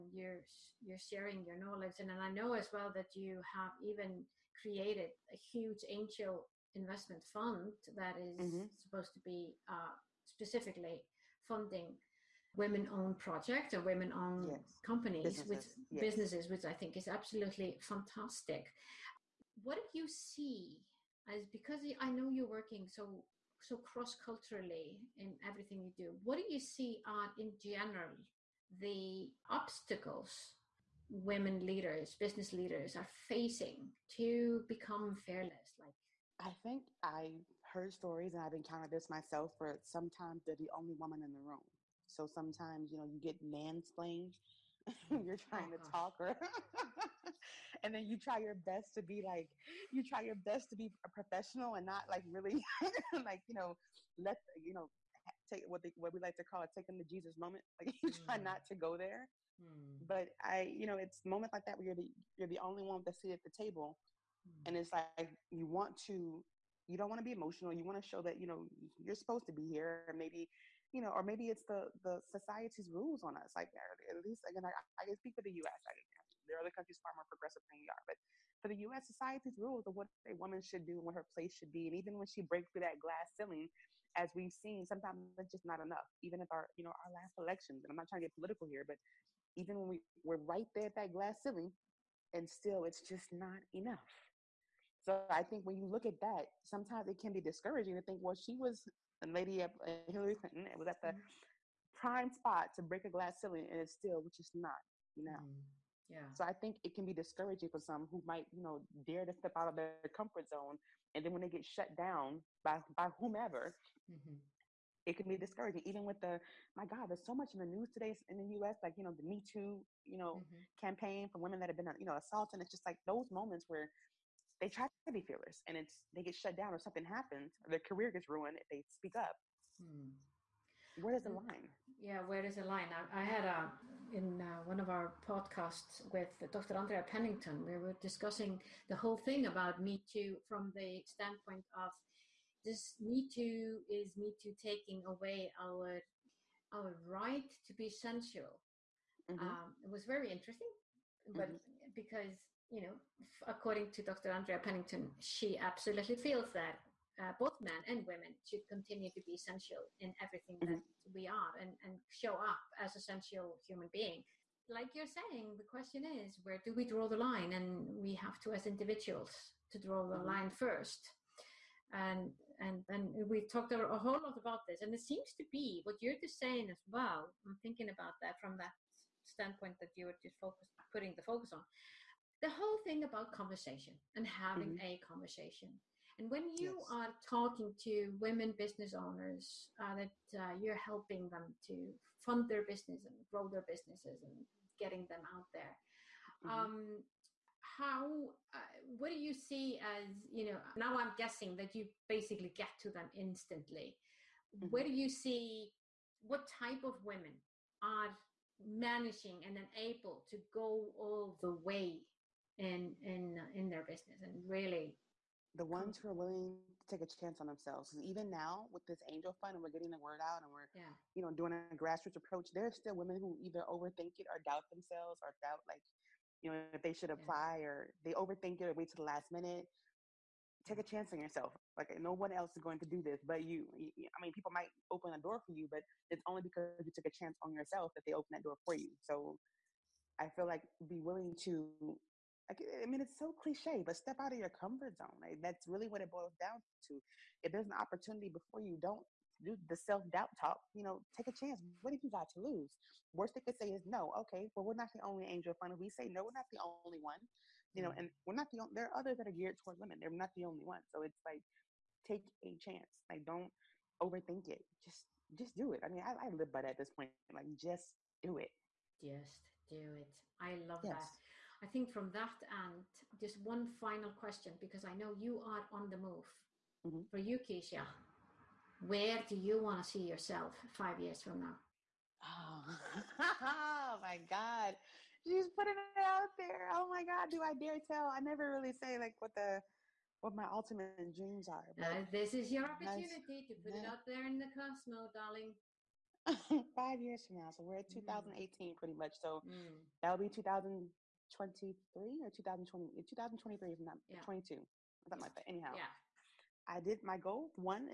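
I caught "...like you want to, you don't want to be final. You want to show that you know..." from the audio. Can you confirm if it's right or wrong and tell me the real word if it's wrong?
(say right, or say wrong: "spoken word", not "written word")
wrong: "emotional", not "final".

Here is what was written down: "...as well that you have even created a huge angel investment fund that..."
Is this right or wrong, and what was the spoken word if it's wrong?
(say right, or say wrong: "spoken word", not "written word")
right.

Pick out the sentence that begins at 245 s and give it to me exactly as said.
Like, that's really what it boils down to.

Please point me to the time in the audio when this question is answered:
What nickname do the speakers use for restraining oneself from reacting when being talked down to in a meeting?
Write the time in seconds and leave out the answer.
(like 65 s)
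56 s.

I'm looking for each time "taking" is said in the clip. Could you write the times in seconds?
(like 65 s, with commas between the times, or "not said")
56 s, 144 s.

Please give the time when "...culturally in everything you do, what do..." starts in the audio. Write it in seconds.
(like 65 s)
24 s.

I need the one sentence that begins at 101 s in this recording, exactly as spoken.
prime spot to break a glass ceiling, and it's still, which is not, you know.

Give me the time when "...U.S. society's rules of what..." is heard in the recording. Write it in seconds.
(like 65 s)
78 s.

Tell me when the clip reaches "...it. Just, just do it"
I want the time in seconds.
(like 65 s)
264 s.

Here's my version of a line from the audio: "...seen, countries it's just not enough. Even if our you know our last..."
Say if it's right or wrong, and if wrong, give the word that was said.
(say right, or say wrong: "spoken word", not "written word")
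wrong: "sometimes", not "countries".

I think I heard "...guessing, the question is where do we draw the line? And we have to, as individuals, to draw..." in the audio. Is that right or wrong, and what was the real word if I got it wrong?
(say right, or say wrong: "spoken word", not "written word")
wrong: "saying", not "guessing".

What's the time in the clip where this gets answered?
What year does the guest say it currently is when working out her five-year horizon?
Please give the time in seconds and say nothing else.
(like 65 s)
298 s.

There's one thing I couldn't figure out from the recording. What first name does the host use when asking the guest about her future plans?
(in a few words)
Kisha.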